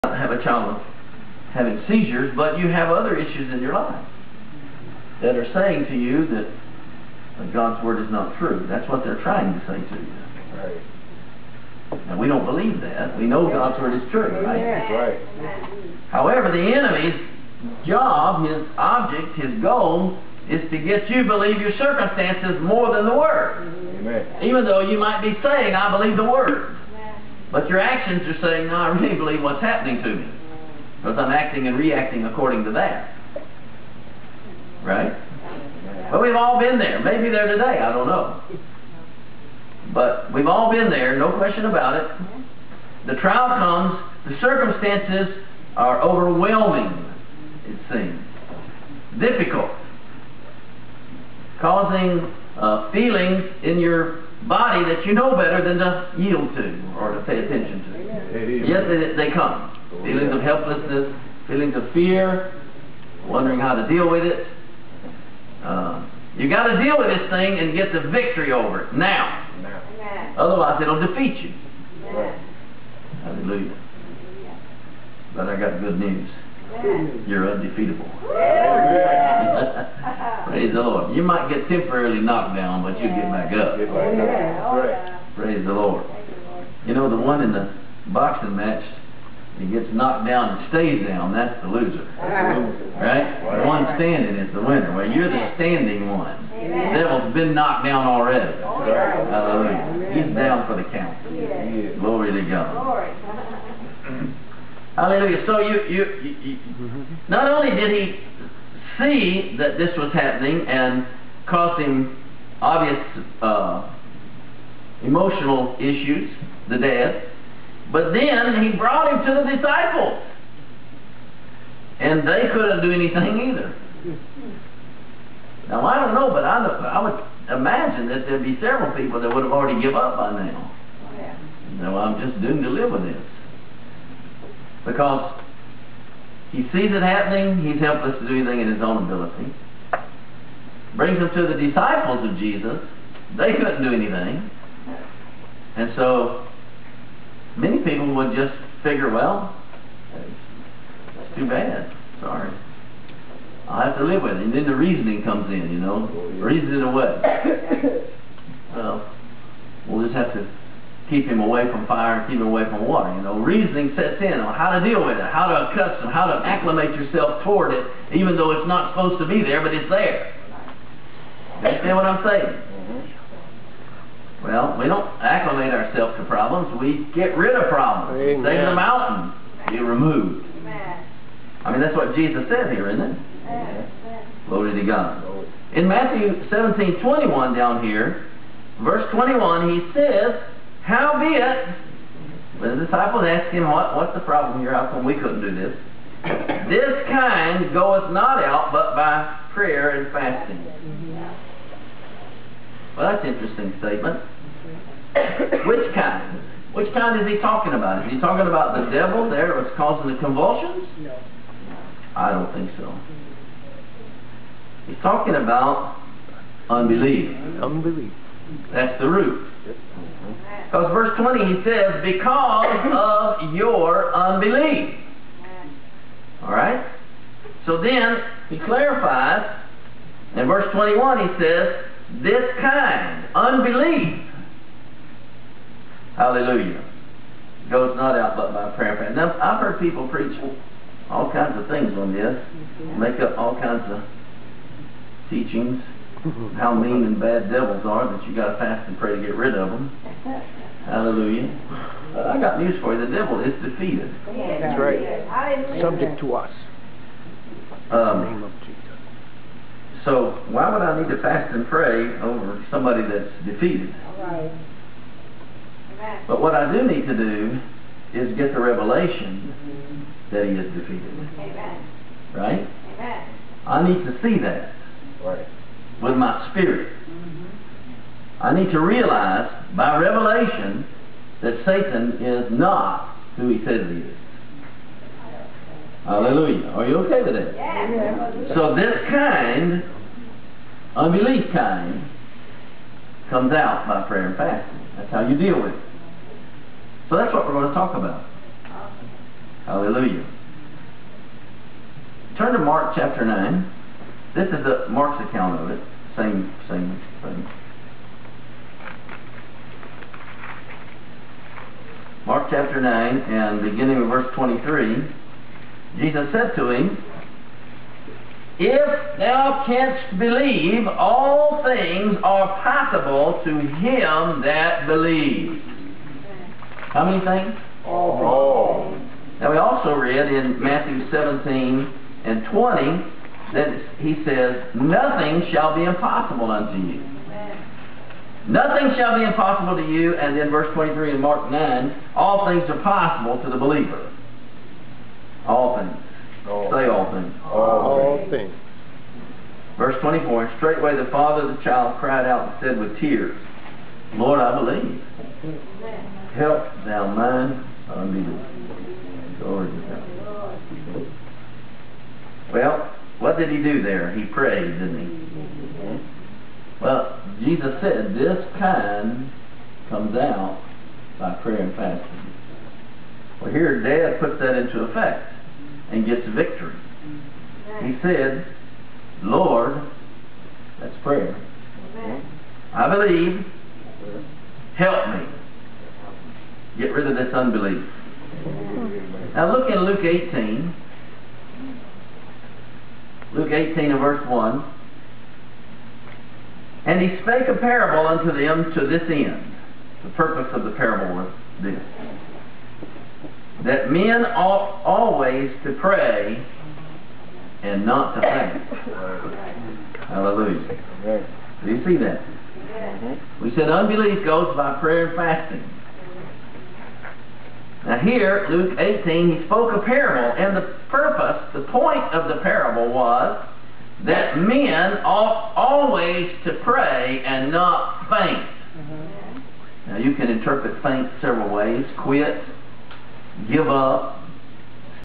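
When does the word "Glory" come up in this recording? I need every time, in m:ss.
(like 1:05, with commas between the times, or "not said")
1:41, 3:04, 5:59.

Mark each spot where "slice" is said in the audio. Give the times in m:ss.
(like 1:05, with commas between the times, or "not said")
not said.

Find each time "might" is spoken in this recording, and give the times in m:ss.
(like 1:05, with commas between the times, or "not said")
0:24, 1:21.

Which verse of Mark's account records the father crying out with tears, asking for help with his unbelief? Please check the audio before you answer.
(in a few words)
Verse 24.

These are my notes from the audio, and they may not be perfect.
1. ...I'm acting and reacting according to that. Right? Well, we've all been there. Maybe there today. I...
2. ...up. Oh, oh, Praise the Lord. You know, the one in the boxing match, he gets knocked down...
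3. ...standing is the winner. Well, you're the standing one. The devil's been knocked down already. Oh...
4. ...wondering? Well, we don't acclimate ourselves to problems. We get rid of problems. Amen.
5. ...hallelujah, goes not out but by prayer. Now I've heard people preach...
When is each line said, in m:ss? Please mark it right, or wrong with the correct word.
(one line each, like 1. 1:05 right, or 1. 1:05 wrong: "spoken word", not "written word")
1. 0:31 right
2. 1:23 right
3. 1:33 right
4. 2:52 wrong: "saying", not "wondering"
5. 3:56 right.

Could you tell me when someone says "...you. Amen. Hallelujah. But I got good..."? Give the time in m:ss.
1:11.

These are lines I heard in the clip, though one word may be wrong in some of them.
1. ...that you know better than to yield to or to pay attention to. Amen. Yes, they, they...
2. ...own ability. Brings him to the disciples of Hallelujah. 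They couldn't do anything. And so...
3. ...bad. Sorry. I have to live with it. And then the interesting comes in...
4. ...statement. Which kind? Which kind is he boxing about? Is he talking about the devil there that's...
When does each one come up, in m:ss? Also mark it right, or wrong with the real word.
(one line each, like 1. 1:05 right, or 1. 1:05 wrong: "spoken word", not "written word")
1. 0:54 right
2. 2:18 wrong: "Jesus", not "Hallelujah"
3. 2:31 wrong: "reasoning", not "interesting"
4. 3:23 wrong: "talking", not "boxing".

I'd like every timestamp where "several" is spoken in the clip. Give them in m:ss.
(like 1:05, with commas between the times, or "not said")
2:08, 7:11.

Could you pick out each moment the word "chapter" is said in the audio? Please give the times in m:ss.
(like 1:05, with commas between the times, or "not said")
5:02, 5:12.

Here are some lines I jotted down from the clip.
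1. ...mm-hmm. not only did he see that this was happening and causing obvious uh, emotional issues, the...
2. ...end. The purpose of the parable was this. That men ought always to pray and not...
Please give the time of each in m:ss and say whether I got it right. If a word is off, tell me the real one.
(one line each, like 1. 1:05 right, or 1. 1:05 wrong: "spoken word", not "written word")
1. 1:46 right
2. 6:39 right.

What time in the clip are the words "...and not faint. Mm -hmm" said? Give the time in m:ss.
7:07.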